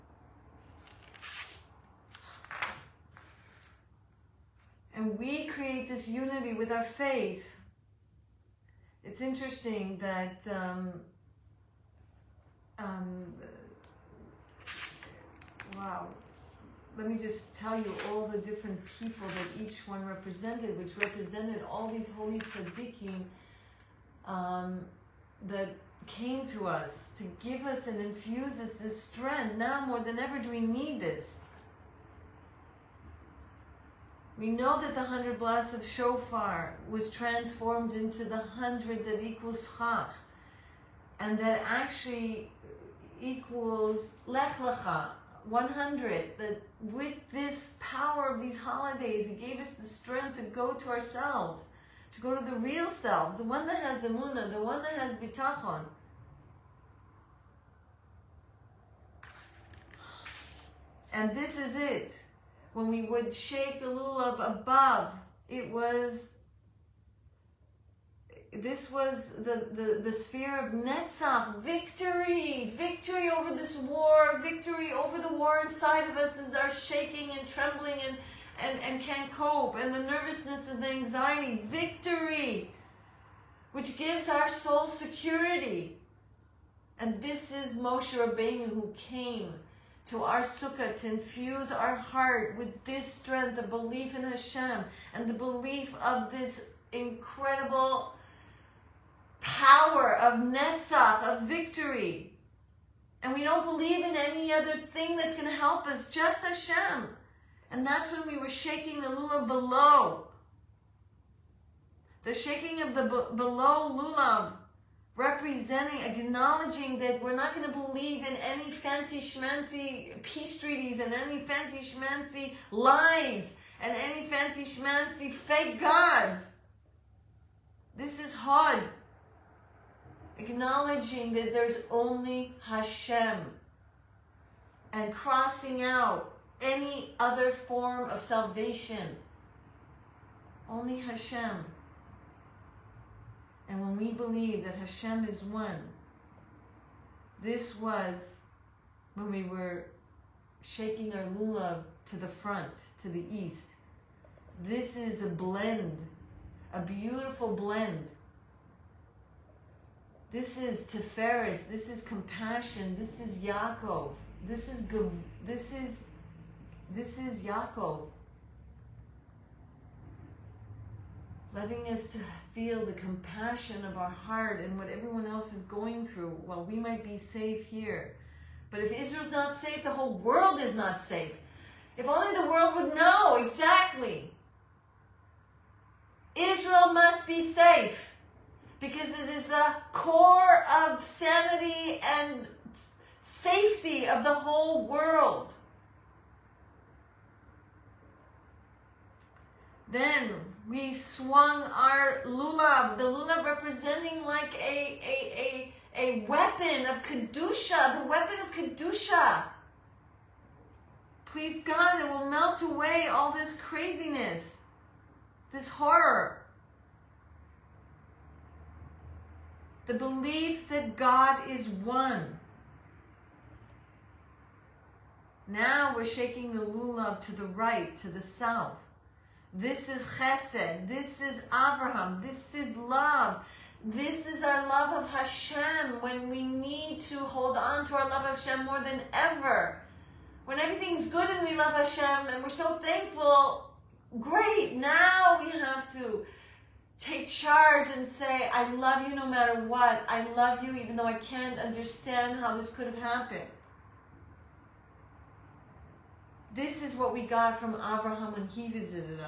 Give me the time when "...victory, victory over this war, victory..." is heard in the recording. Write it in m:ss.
1:11.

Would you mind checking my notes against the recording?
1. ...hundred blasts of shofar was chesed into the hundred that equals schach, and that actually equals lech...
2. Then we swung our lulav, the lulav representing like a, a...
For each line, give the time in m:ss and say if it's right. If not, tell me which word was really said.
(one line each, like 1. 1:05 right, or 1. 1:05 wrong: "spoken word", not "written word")
1. 0:35 wrong: "transformed", not "chesed"
2. 3:19 right.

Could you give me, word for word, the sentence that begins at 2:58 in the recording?
But if Israel's not safe, the whole world is not safe.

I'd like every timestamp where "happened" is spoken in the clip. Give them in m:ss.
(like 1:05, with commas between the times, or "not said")
4:12.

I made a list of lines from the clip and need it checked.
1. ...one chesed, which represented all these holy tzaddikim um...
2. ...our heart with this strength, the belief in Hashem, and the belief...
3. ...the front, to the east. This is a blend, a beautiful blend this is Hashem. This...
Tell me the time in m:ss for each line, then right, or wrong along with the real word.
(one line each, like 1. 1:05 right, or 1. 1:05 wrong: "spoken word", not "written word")
1. 0:19 wrong: "represented", not "chesed"
2. 1:31 right
3. 2:32 wrong: "Tiferes", not "Hashem".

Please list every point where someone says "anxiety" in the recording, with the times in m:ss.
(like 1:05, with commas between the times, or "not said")
1:20.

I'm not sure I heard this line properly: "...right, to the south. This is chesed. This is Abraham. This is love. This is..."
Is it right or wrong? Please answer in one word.
right.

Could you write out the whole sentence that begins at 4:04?
Now we have to take charge and say, I love you no matter what.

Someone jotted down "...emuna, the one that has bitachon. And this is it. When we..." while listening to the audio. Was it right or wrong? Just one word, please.
right.